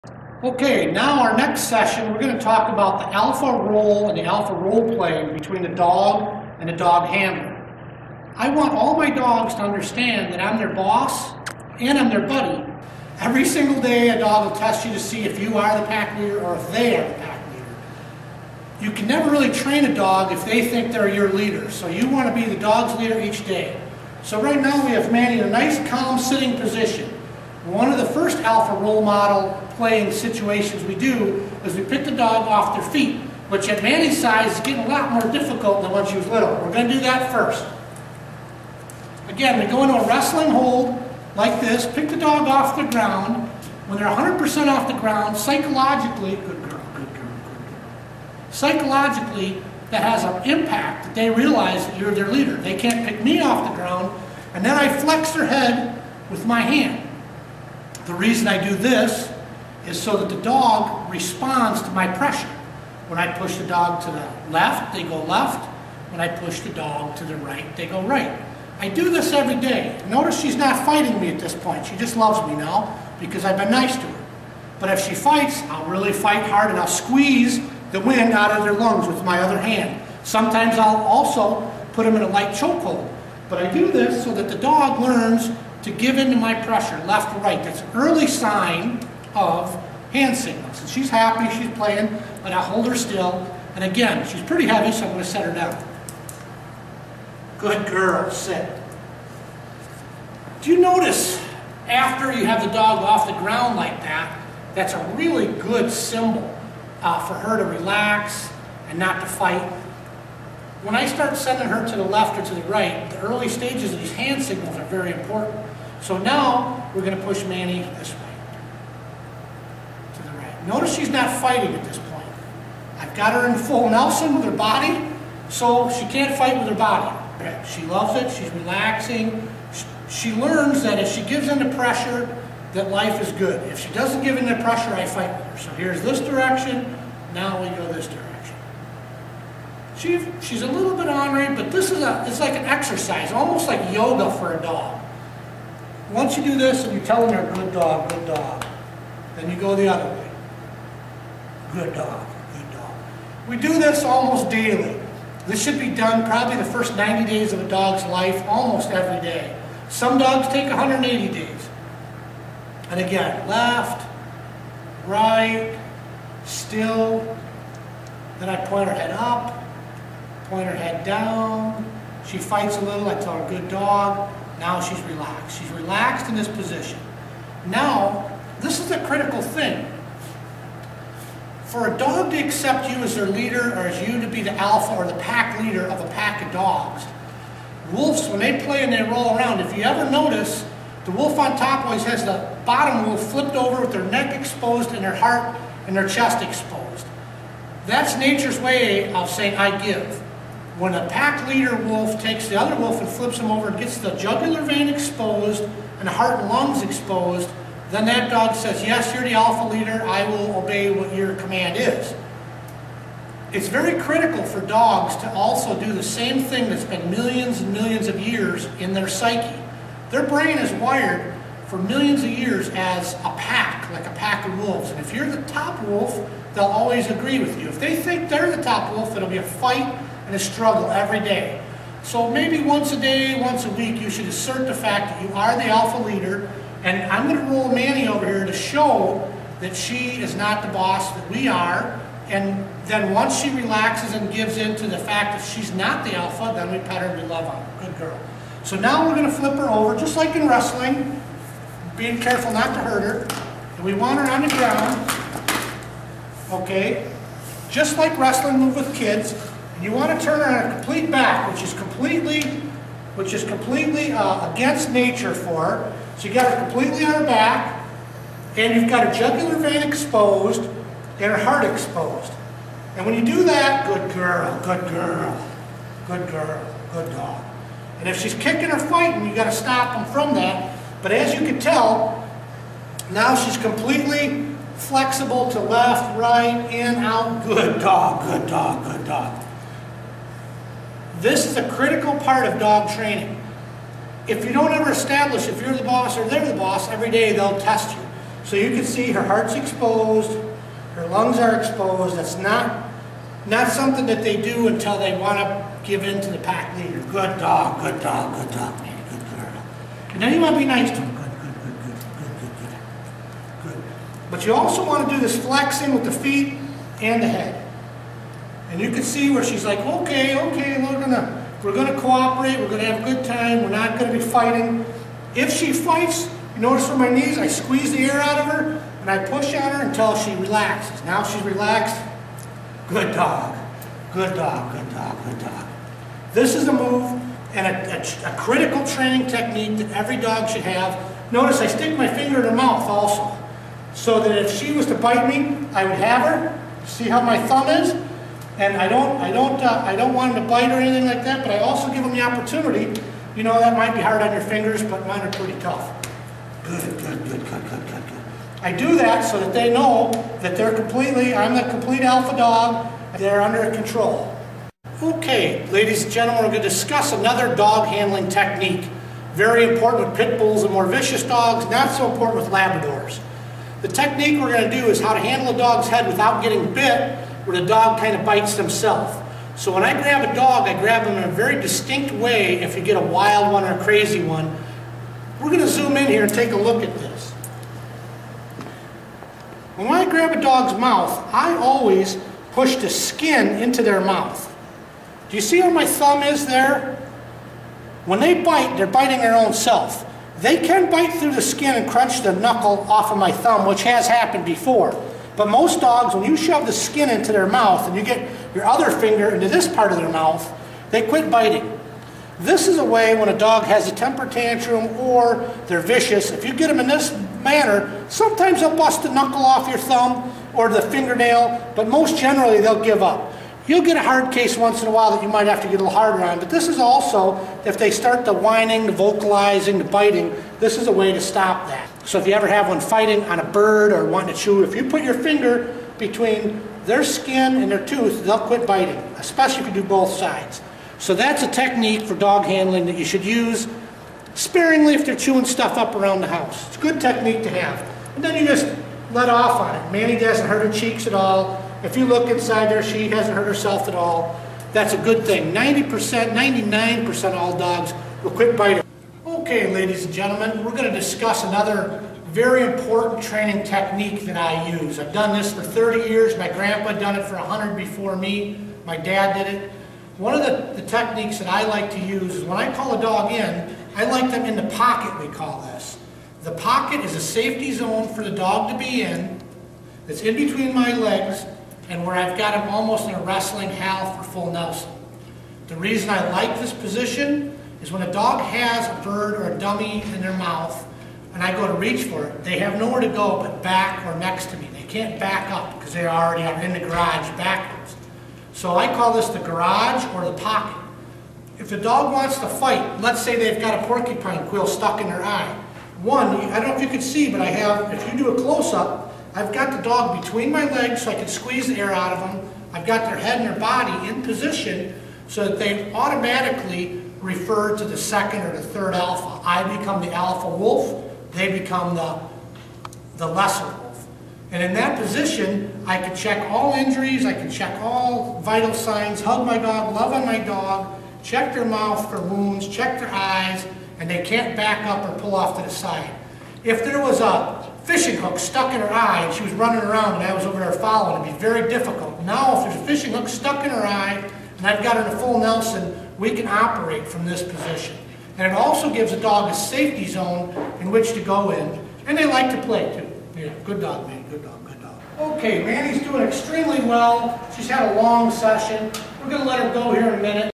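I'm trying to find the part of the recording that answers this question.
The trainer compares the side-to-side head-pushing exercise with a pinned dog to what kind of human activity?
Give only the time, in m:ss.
2:23.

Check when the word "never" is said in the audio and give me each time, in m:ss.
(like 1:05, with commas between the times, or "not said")
0:19.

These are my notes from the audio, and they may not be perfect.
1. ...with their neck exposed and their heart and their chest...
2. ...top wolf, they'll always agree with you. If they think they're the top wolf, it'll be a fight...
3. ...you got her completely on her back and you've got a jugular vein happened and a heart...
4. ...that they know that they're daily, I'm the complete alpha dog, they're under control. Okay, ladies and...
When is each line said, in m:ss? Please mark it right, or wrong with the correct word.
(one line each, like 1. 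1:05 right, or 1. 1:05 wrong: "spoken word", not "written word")
1. 3:13 right
2. 3:45 right
3. 4:26 wrong: "exposed", not "happened"
4. 5:59 wrong: "completely", not "daily".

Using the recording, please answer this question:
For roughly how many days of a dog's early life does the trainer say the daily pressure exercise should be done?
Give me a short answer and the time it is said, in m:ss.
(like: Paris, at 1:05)
90 days, at 2:36.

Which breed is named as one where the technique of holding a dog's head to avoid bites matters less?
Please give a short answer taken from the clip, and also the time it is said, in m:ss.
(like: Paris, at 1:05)
Labradors, at 6:12.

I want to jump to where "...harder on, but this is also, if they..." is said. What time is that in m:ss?
7:05.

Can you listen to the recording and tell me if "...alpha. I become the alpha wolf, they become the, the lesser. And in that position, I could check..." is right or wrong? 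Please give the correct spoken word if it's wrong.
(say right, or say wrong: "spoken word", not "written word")
right.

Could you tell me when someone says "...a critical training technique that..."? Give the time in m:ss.
5:38.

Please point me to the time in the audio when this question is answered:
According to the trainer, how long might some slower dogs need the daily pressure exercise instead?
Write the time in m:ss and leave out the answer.
2:40.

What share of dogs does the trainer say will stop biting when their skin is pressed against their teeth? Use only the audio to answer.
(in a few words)
99%.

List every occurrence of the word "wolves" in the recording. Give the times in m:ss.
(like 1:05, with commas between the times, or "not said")
3:07, 3:44.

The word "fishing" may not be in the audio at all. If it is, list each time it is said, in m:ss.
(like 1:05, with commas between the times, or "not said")
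8:57, 9:02.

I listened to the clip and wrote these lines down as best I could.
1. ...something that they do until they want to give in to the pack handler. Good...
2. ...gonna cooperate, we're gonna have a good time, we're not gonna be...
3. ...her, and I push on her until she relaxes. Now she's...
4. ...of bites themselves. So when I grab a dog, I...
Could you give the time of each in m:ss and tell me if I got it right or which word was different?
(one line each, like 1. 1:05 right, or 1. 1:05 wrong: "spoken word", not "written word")
1. 5:03 wrong: "leader", not "handler"
2. 5:21 right
3. 5:28 right
4. 6:18 right.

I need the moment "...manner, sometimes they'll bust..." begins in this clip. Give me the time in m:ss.
6:57.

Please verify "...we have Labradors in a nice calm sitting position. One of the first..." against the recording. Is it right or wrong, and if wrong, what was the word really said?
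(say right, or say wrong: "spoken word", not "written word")
wrong: "Manny", not "Labradors".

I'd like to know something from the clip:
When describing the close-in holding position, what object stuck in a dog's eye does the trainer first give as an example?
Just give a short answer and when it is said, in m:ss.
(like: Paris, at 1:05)
Porcupine quill, at 8:23.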